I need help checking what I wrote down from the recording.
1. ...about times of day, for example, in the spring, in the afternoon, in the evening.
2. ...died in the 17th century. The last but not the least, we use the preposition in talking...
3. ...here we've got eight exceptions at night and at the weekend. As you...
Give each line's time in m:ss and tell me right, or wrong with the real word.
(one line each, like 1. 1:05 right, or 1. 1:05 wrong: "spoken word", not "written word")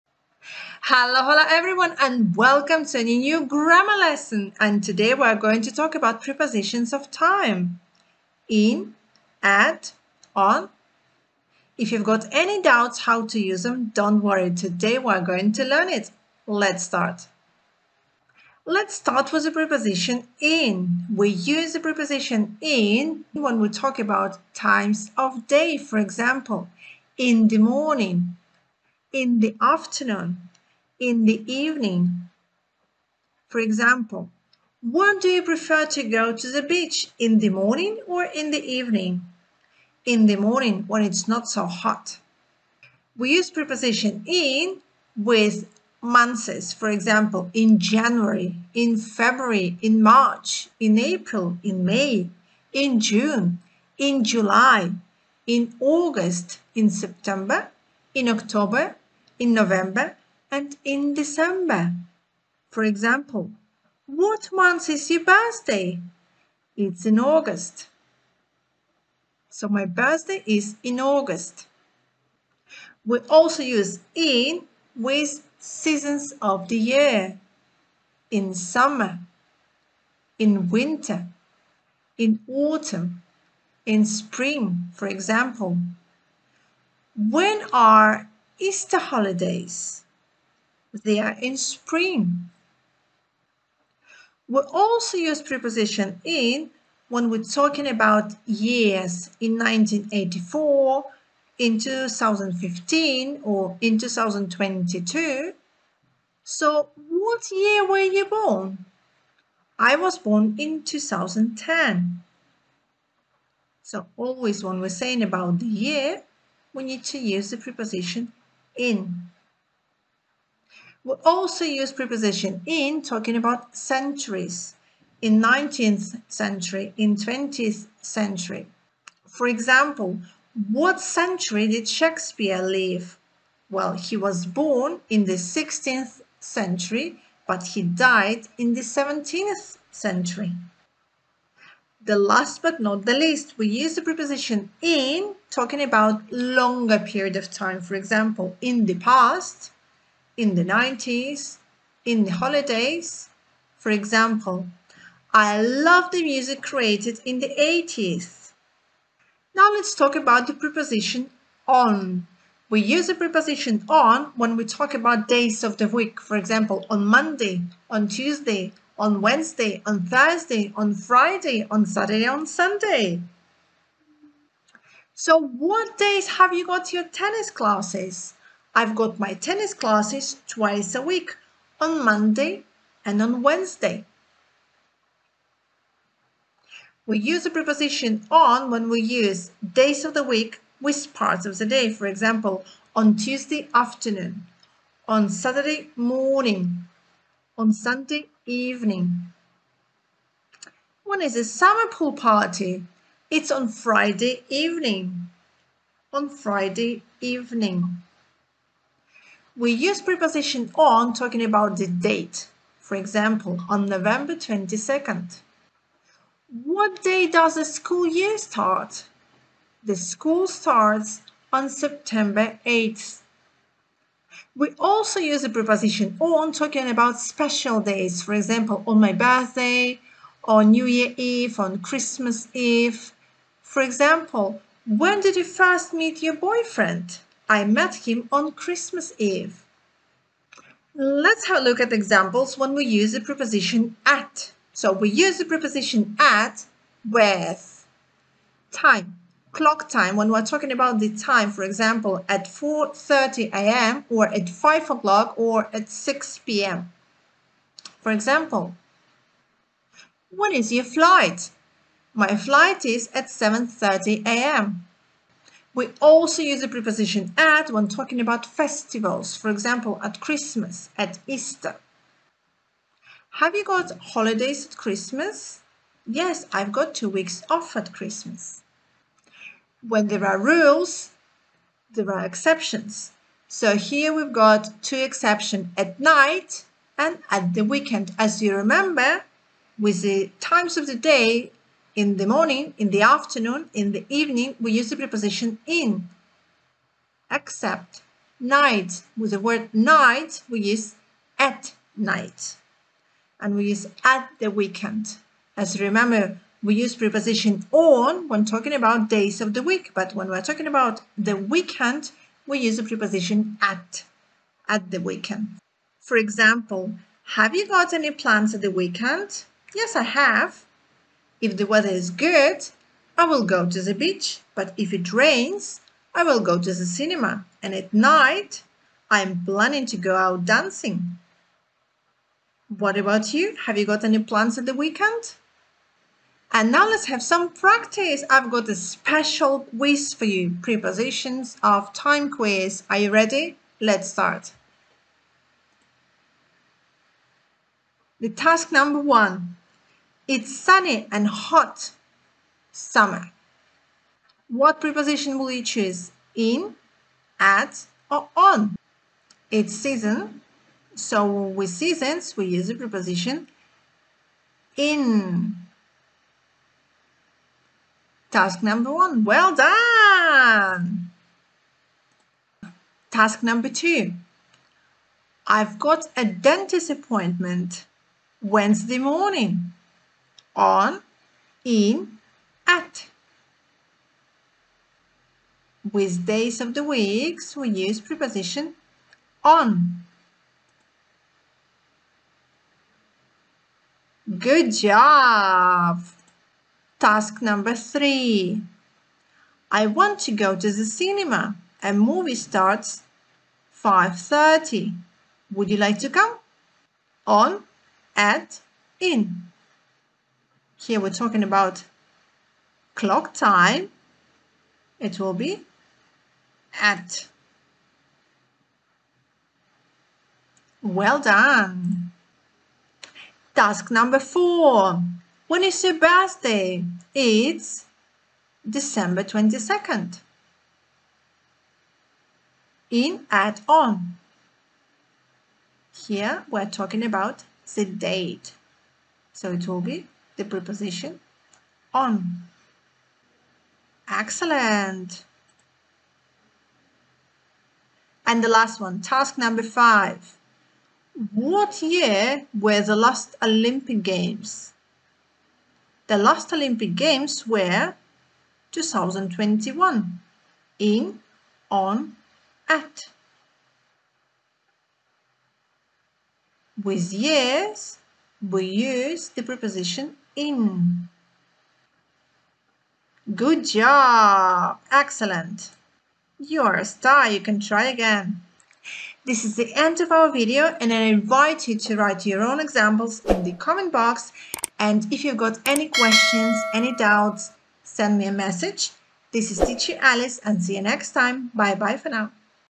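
1. 0:23 wrong: "morning", not "spring"
2. 2:17 right
3. 4:43 wrong: "two", not "eight".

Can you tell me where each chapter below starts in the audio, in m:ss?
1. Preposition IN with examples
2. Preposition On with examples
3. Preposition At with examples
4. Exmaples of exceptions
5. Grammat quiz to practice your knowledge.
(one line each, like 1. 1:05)
1. 0:18
2. 2:40
3. 4:05
4. 4:37
5. 5:37.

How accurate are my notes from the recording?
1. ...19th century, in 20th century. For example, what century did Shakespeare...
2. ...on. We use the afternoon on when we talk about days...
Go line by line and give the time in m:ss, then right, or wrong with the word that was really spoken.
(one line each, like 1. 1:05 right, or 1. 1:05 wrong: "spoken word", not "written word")
1. 2:05 right
2. 2:41 wrong: "preposition", not "afternoon".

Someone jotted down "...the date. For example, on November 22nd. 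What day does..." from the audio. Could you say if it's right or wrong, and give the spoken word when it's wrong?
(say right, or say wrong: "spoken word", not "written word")
right.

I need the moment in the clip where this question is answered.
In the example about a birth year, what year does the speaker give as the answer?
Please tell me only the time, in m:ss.
1:49.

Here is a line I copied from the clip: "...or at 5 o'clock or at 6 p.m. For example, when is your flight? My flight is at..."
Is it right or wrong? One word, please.
right.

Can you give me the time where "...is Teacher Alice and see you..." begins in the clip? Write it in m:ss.
8:09.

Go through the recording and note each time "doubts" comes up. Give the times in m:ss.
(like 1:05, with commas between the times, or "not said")
0:12, 8:06.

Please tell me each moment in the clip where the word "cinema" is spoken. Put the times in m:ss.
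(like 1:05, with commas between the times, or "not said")
5:26, 6:40.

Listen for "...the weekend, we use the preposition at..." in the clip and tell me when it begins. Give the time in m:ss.
5:11.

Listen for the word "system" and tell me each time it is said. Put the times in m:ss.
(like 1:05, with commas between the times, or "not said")
not said.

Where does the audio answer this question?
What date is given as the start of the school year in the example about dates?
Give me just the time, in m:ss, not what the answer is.
3:41.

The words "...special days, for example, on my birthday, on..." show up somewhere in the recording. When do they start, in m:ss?
3:47.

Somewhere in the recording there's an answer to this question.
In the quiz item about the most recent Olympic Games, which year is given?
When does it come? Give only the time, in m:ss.
7:38.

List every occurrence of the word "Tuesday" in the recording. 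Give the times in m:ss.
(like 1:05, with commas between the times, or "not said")
2:48, 3:13.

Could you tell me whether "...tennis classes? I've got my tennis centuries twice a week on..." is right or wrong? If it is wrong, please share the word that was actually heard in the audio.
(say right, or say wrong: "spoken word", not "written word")
wrong: "classes", not "centuries".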